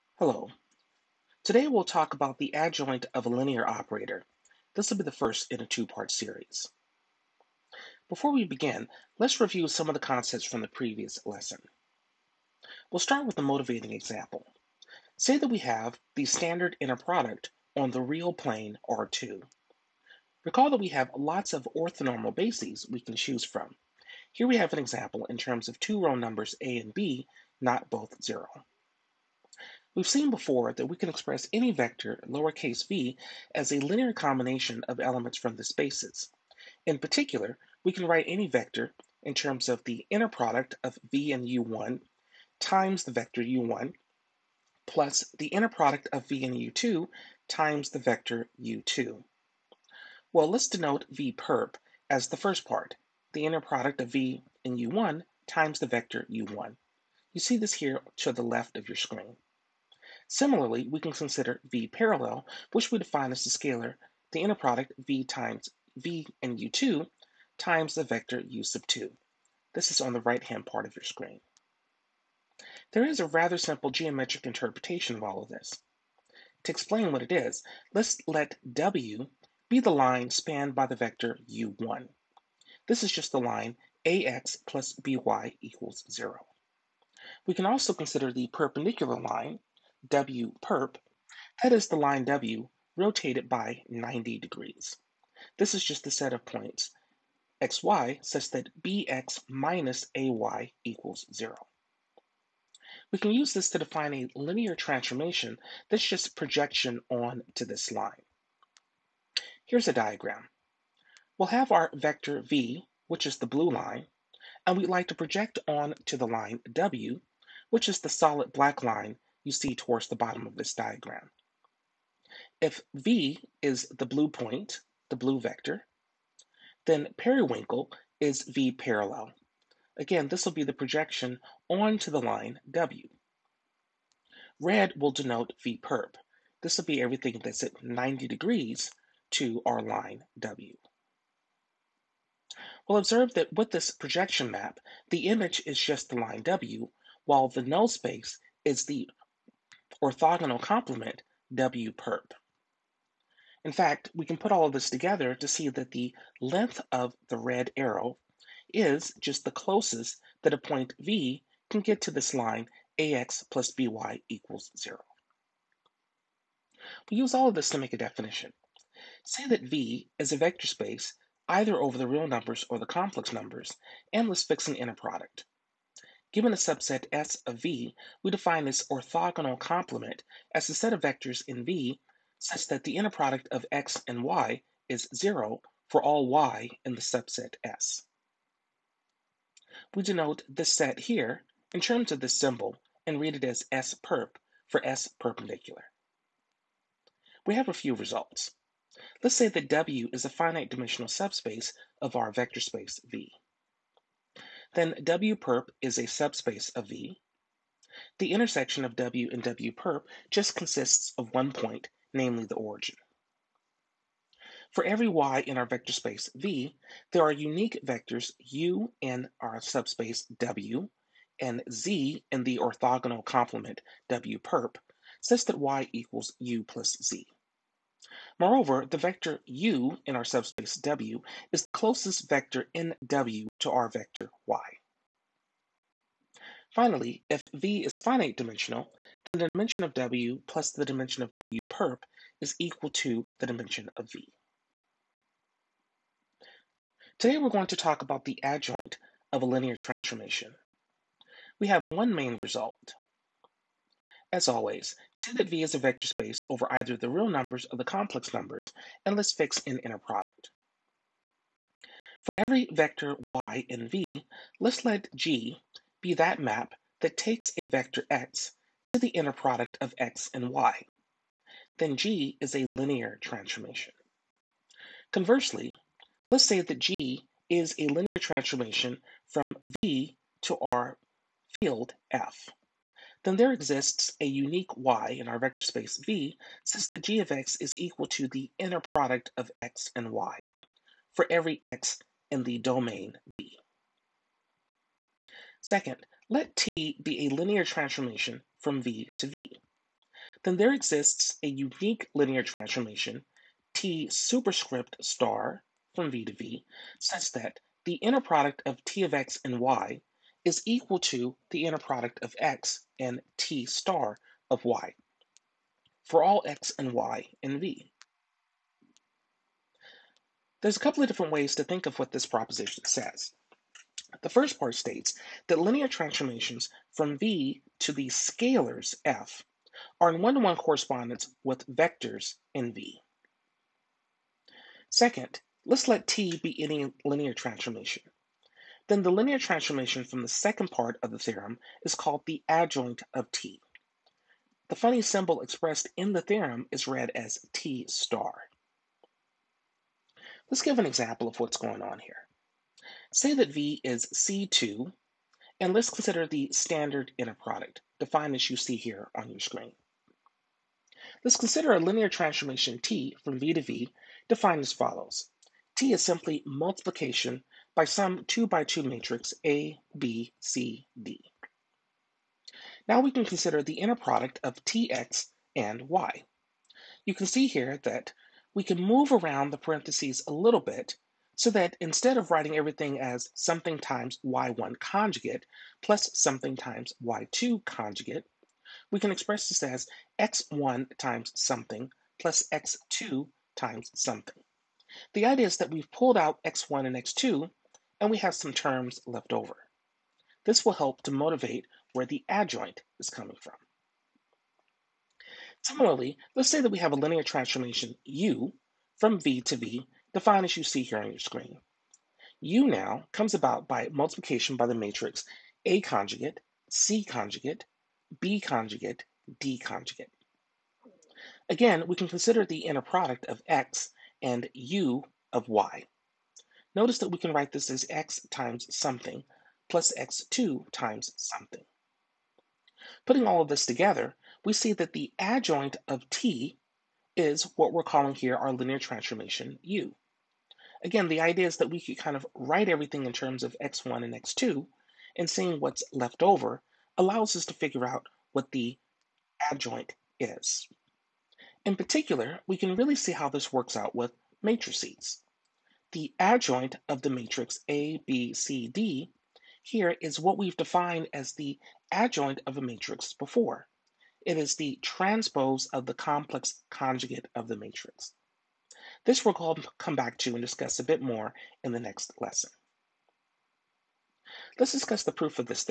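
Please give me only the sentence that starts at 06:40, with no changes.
This will help to motivate where the adjoint is coming from.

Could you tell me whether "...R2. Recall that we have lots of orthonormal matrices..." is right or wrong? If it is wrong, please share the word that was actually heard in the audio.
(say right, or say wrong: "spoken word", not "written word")
wrong: "bases", not "matrices".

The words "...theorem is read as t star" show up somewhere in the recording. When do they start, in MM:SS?
05:46.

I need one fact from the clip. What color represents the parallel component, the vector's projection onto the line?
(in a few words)
Periwinkle.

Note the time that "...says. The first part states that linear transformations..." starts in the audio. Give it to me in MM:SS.
05:22.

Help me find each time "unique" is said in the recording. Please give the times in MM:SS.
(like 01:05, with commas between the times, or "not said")
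03:37, 04:44, 05:01.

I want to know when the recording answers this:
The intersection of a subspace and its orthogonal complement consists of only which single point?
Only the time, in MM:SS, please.
03:32.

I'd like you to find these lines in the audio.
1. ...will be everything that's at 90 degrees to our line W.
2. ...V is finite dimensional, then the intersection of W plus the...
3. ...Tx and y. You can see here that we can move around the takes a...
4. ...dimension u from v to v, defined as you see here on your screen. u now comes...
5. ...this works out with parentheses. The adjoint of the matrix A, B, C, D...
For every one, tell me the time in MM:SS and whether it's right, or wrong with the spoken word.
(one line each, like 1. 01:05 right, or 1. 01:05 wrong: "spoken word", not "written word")
1. 02:16 right
2. 03:57 wrong: "dimension", not "intersection"
3. 06:14 wrong: "parentheses", not "takes"
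4. 06:47 wrong: "transformation", not "dimension"
5. 07:33 wrong: "matrices", not "parentheses".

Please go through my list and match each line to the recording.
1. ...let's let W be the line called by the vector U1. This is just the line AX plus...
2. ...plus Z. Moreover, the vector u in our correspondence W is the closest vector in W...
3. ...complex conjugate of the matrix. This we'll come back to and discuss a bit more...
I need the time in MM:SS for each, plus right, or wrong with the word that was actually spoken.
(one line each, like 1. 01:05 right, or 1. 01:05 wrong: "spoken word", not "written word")
1. 01:17 wrong: "spanned", not "called"
2. 03:46 wrong: "subspace", not "correspondence"
3. 07:45 right.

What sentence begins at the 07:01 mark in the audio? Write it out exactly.
Again, we can consider the inner product of x and u of y.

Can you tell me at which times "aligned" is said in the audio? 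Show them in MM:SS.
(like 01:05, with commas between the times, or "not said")
not said.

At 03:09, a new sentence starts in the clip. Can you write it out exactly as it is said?
We denote this set here in terms of this symbol and read it as S perp for S perpendicular.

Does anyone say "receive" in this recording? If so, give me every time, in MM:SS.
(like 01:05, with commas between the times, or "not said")
not said.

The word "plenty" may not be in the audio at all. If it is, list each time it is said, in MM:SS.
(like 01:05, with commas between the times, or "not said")
not said.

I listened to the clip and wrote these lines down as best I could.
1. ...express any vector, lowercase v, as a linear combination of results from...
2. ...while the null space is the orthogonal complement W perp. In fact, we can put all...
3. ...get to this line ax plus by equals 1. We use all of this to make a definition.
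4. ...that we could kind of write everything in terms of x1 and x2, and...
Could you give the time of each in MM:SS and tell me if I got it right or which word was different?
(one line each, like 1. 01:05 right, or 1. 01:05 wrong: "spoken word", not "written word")
1. 00:31 wrong: "elements", not "results"
2. 02:27 right
3. 02:41 wrong: "0", not "1"
4. 07:21 right.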